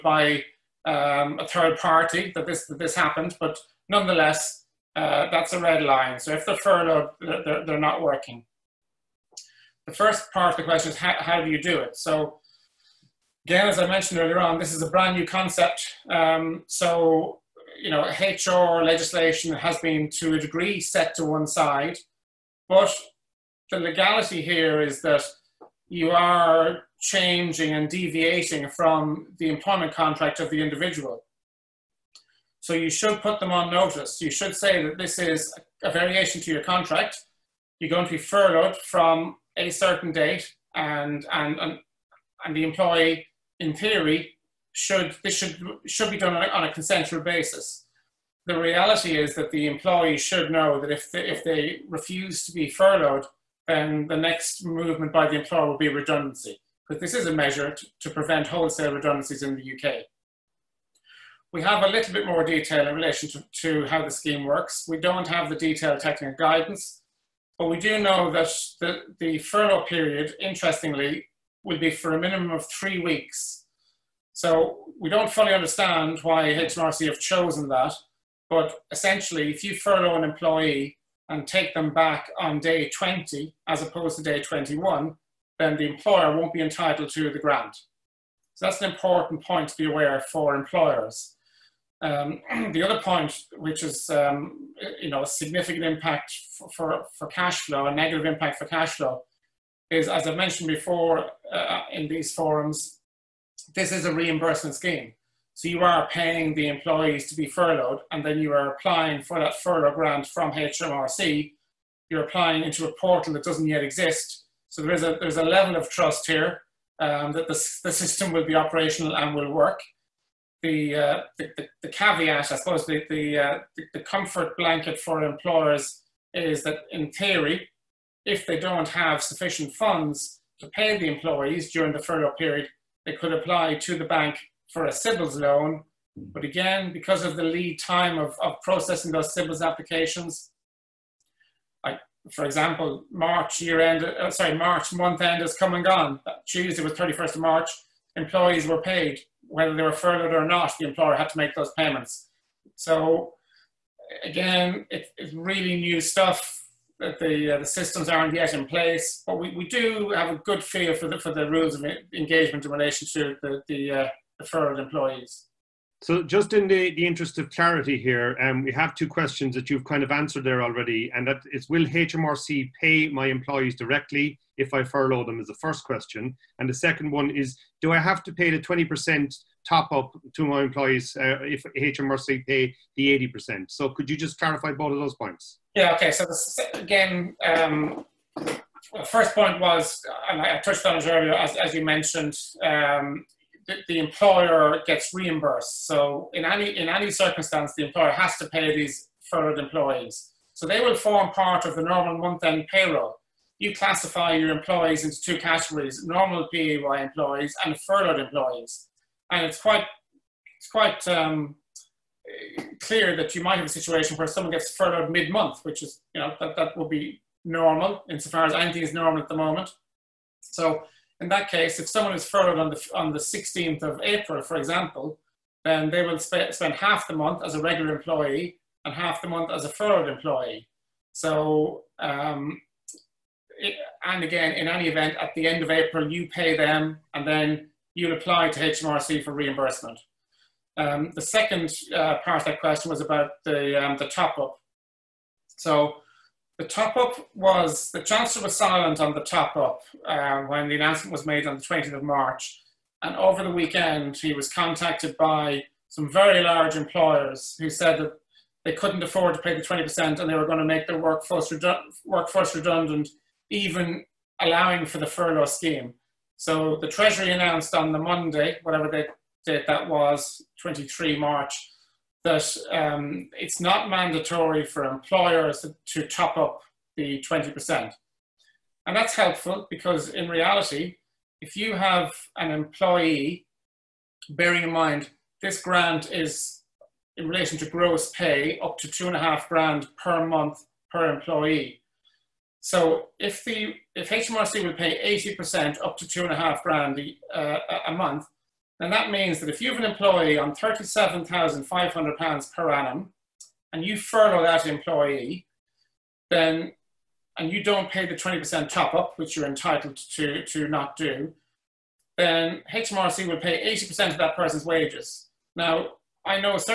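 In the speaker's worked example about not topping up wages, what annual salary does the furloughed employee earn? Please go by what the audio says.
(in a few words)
£37,500.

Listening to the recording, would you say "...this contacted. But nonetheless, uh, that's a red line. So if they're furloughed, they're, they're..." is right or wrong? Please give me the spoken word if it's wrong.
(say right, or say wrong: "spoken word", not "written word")
wrong: "happened", not "contacted".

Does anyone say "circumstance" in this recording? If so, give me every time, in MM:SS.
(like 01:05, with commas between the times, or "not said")
03:17.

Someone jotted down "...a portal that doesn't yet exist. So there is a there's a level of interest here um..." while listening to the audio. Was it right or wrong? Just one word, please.
wrong.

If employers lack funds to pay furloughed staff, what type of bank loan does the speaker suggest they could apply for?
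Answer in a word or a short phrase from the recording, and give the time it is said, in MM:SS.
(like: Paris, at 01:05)
CBILS loan, at 02:14.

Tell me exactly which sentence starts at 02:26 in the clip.
Tuesday was 31st of March, employees were paid whether they were furloughed or not, the employer had to make those payments.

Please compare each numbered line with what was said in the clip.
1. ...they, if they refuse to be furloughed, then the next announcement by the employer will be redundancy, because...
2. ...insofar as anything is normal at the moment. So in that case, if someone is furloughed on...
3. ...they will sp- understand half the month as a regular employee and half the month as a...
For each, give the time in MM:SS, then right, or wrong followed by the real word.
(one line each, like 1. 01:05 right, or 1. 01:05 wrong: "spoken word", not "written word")
1. 00:51 wrong: "movement", not "announcement"
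2. 03:38 right
3. 03:45 wrong: "spend", not "understand".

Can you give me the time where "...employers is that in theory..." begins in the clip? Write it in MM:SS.
02:05.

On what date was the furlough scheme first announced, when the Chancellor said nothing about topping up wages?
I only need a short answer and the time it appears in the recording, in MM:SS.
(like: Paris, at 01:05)
20th of March, at 04:11.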